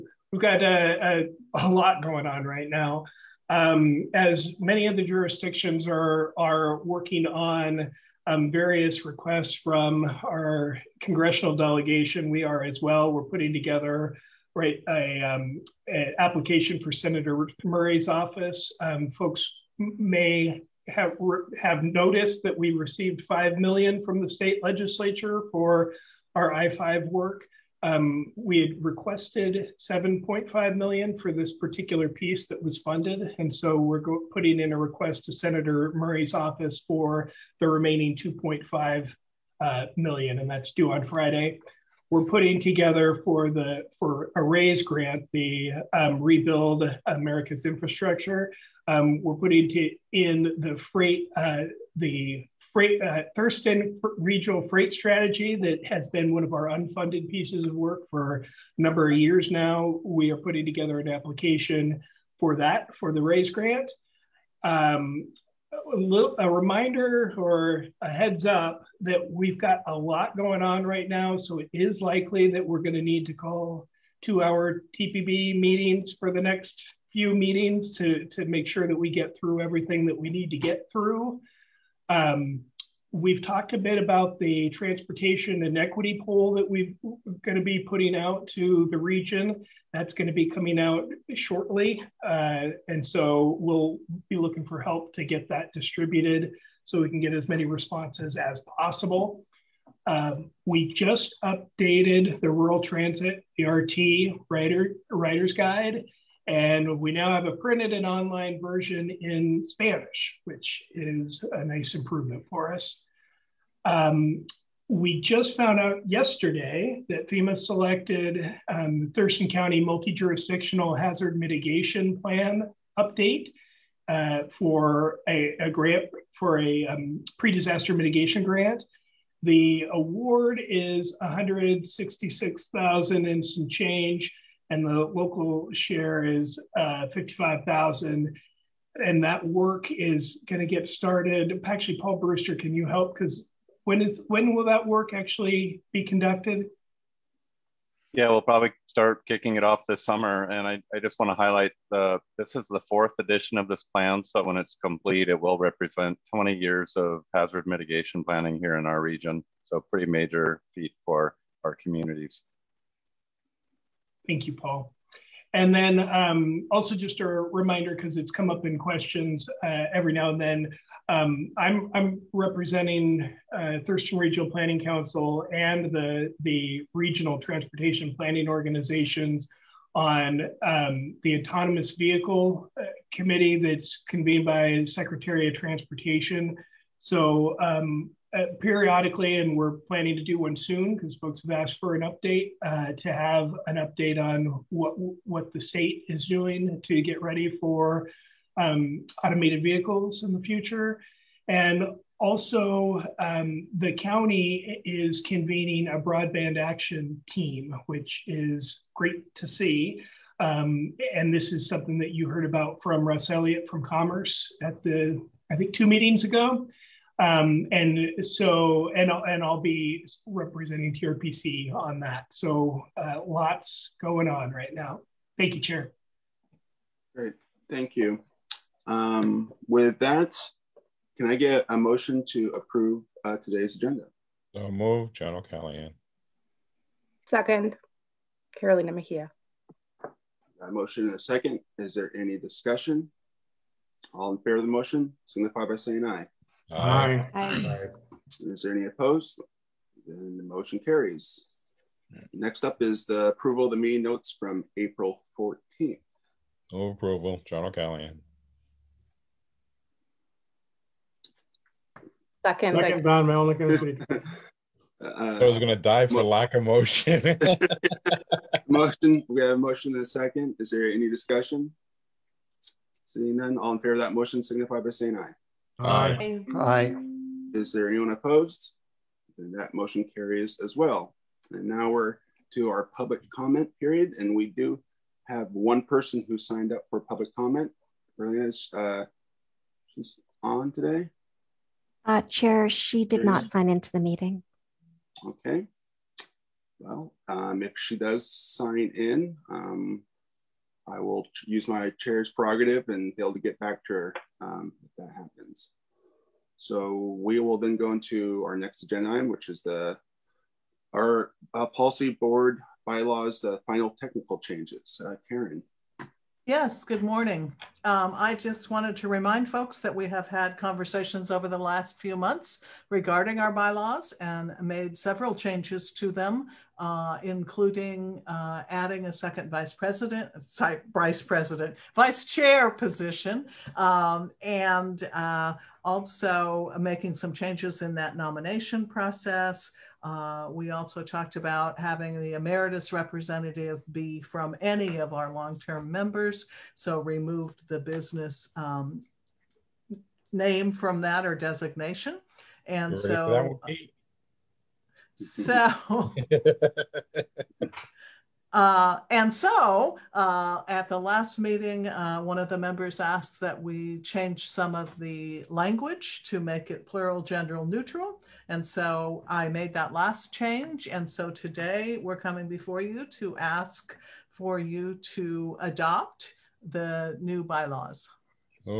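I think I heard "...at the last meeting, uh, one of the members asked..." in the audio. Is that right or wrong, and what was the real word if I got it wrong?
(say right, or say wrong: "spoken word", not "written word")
right.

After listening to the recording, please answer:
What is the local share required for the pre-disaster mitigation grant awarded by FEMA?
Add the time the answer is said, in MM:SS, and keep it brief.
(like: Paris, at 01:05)
55,000, at 02:17.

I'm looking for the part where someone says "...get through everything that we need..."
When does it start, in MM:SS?
01:19.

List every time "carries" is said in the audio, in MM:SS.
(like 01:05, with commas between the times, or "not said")
04:10, 04:40.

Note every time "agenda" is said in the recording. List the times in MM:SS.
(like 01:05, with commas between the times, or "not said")
03:53, 05:08.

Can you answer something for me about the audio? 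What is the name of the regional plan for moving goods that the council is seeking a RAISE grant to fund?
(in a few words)
Thurston Regional Freight Strategy.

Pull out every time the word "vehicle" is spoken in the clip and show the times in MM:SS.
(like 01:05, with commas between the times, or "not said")
03:01, 03:19.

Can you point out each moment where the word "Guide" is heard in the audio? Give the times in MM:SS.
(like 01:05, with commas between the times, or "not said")
01:45.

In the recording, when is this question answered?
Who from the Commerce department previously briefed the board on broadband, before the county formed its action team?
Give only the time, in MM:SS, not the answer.
03:33.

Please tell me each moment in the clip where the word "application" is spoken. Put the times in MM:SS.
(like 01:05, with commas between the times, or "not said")
00:16, 01:01.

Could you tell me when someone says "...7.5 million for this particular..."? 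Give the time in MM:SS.
00:29.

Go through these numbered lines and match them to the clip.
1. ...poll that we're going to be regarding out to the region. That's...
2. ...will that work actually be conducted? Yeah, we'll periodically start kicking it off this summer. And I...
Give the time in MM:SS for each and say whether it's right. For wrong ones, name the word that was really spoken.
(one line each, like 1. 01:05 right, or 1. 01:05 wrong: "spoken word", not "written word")
1. 01:26 wrong: "putting", not "regarding"
2. 02:24 wrong: "probably", not "periodically".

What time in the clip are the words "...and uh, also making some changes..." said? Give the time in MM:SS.
05:34.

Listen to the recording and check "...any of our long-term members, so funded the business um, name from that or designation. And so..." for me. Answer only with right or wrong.
wrong.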